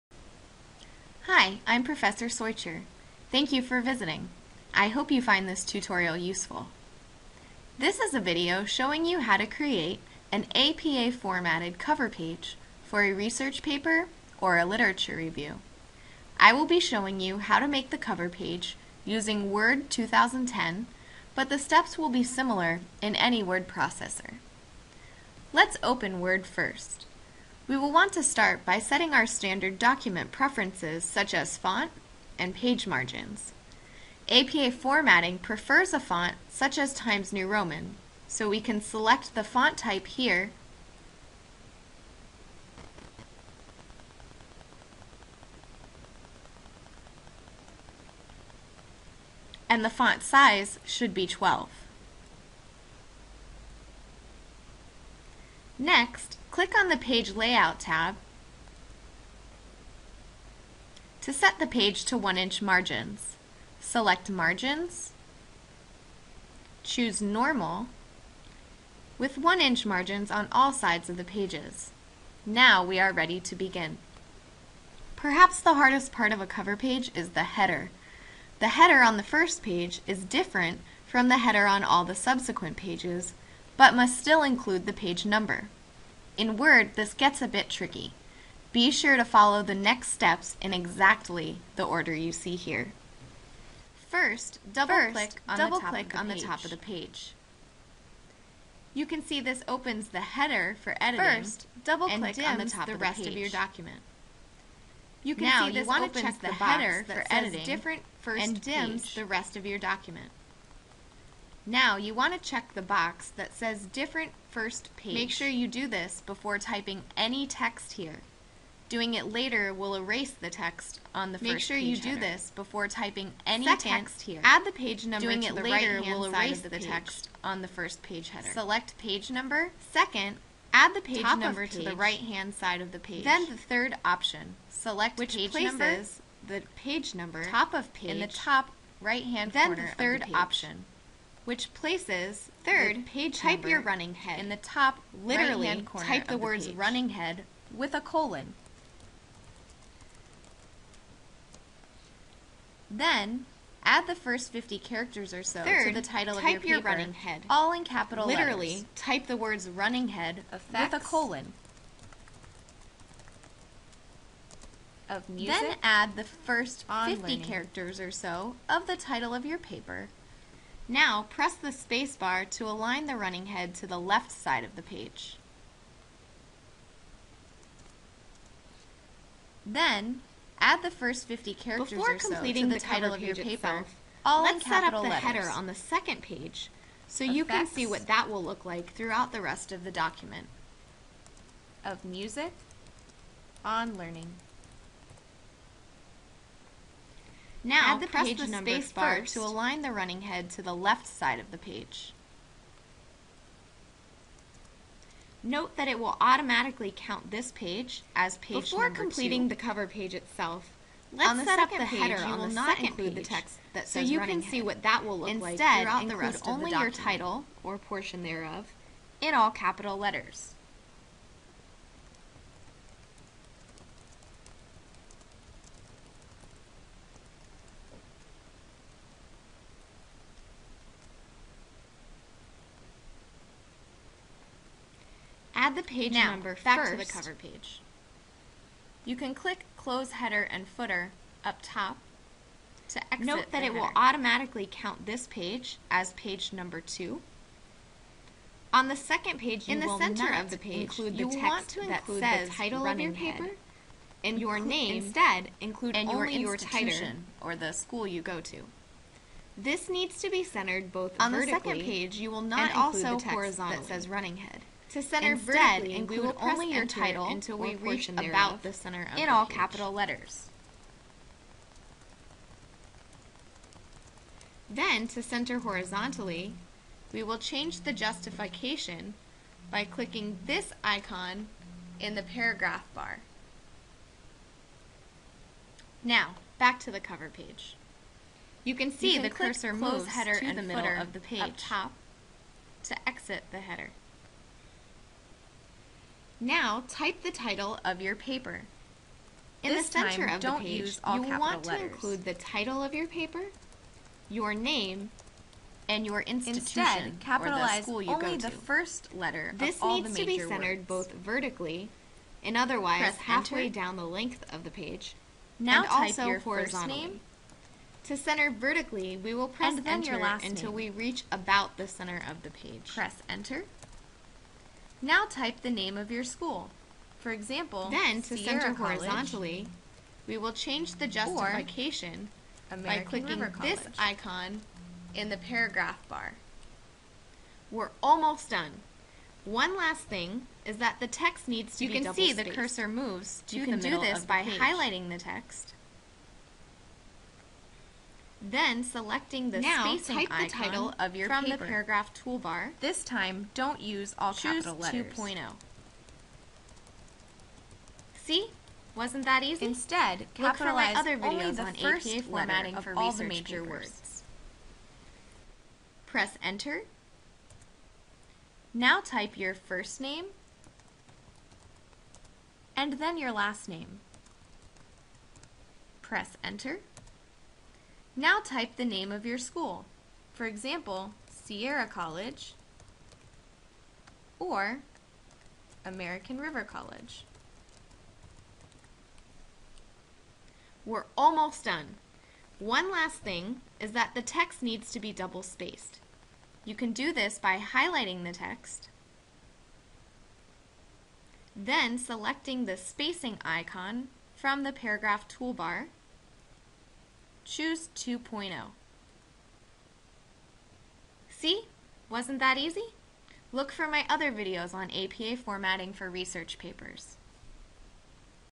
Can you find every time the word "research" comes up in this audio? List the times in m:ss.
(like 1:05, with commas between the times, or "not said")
0:13, 6:56.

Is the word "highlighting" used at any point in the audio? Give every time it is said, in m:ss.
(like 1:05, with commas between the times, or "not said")
5:44, 6:37.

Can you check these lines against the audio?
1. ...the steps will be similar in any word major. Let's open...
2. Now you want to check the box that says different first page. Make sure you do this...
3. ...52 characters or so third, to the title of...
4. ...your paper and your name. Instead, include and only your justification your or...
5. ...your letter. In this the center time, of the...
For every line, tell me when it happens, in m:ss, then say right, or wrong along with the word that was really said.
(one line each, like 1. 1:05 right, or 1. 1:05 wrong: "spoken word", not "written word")
1. 0:21 wrong: "processor", not "major"
2. 1:51 right
3. 2:34 wrong: "50", not "52"
4. 4:12 wrong: "institution", not "justification"
5. 4:58 wrong: "paper", not "letter".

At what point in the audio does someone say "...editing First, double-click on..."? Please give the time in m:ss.
1:40.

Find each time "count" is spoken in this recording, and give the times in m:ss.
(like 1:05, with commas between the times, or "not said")
3:26, 4:04.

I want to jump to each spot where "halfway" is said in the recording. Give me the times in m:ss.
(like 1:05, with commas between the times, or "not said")
5:13.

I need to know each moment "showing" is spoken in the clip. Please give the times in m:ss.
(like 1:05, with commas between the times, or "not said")
0:08, 0:16.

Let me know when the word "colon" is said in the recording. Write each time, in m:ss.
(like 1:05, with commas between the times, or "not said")
2:28, 2:40.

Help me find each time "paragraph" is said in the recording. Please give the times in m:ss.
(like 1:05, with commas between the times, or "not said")
4:42, 5:35, 5:51, 6:44.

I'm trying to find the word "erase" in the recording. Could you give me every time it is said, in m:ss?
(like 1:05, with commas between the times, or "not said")
1:59, 2:06.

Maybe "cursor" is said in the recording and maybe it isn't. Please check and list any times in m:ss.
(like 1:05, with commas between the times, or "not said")
4:49, 5:42.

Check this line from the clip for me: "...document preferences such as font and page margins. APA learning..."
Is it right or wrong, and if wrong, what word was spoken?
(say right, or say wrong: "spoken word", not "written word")
wrong: "formatting", not "learning".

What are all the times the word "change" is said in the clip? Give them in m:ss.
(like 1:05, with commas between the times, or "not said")
4:37, 5:30.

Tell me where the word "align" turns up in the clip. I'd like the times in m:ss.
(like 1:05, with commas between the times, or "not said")
2:52, 3:19.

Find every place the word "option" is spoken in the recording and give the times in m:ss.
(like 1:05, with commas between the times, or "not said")
2:14, 2:20.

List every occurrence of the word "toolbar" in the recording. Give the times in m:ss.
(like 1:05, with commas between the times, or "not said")
5:52, 6:45.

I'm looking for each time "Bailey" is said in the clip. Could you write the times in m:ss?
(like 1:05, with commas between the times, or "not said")
not said.